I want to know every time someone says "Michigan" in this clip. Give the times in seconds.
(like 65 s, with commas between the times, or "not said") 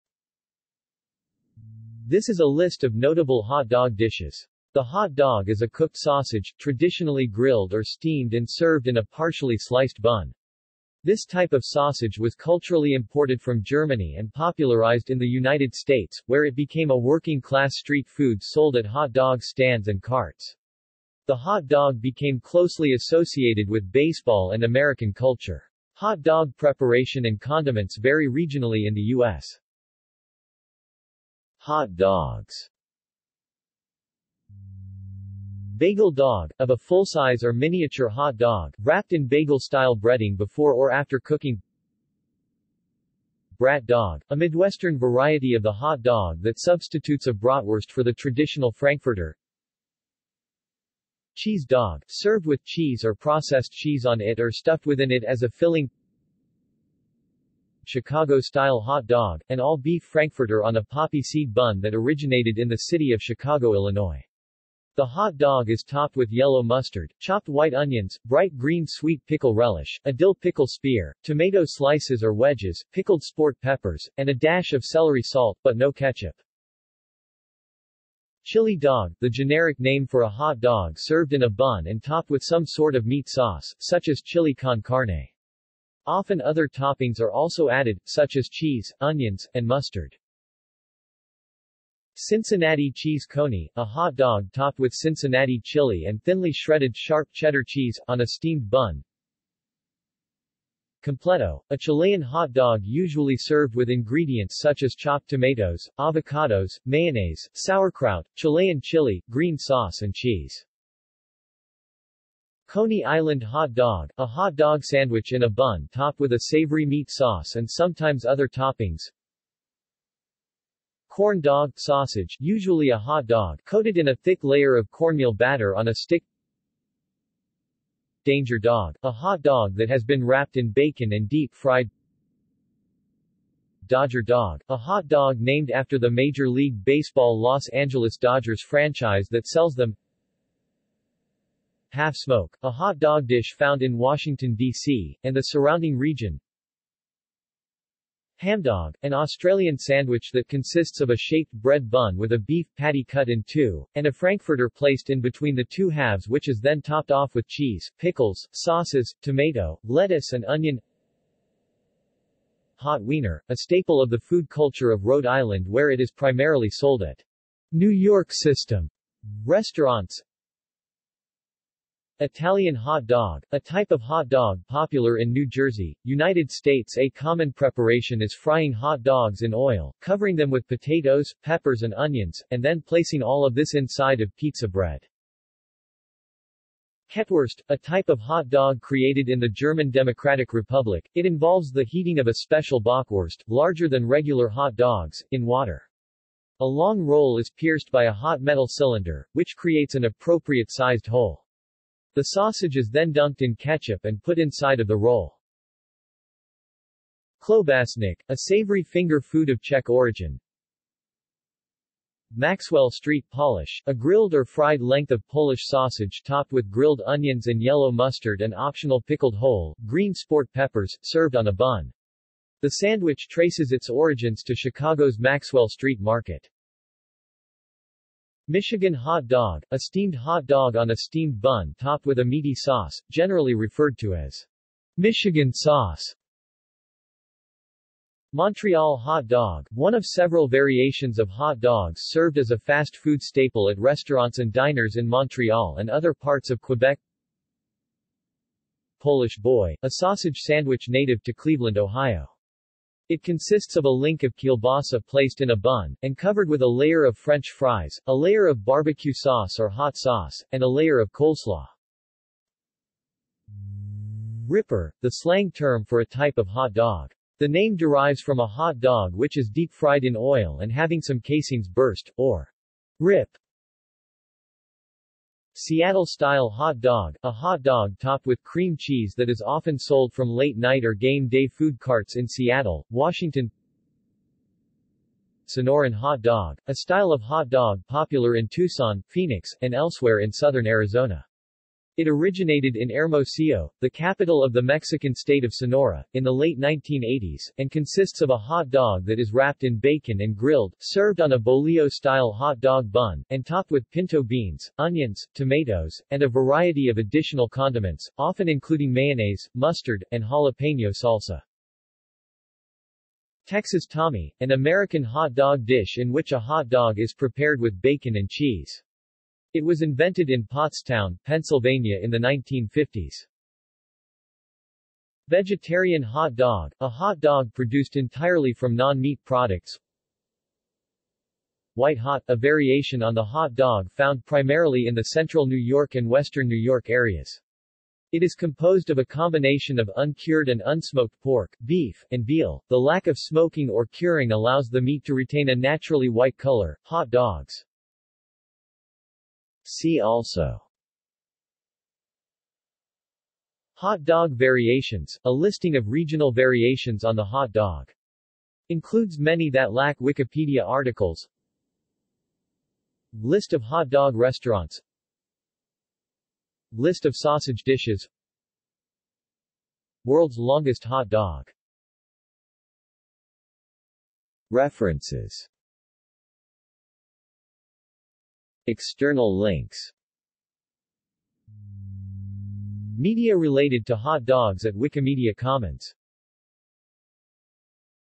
228 s, 234 s.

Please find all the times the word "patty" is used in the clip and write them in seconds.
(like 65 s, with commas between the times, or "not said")
152 s.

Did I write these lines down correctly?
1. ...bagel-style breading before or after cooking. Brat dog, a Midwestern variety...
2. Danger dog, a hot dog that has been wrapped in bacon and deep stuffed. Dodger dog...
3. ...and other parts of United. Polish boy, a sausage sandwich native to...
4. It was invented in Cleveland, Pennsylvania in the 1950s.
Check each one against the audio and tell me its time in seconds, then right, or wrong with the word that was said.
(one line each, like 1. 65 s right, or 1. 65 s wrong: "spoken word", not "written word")
1. 39 s right
2. 128 s wrong: "fried", not "stuffed"
3. 245 s wrong: "Quebec", not "United"
4. 319 s wrong: "Pottstown", not "Cleveland".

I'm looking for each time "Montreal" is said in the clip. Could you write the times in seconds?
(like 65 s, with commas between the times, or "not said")
238 s, 245 s.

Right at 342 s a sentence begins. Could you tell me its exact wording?
The lack of smoking or curing allows the meat to retain a naturally white color.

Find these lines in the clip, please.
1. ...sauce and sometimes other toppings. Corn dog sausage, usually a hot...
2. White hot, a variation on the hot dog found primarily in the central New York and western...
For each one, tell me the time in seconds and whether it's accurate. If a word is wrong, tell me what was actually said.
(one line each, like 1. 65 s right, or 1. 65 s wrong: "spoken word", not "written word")
1. 117 s right
2. 331 s right.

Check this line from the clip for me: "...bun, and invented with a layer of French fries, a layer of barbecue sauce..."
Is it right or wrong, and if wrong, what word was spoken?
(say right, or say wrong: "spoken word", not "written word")
wrong: "covered", not "invented".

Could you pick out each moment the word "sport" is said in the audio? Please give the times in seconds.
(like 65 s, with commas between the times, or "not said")
73 s, 220 s.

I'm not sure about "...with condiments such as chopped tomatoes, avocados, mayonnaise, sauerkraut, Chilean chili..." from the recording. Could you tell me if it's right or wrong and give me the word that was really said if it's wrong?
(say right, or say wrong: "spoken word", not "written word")
wrong: "ingredients", not "condiments".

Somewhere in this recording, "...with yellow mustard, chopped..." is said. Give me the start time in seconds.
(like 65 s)
66 s.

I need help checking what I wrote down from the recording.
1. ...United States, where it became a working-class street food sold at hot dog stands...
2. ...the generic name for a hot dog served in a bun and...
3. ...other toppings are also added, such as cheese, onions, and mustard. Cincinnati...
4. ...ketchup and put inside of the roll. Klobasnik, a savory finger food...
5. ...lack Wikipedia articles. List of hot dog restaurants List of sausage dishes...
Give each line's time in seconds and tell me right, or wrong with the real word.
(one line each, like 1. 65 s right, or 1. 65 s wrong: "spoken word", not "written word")
1. 15 s right
2. 79 s right
3. 86 s right
4. 203 s right
5. 359 s right.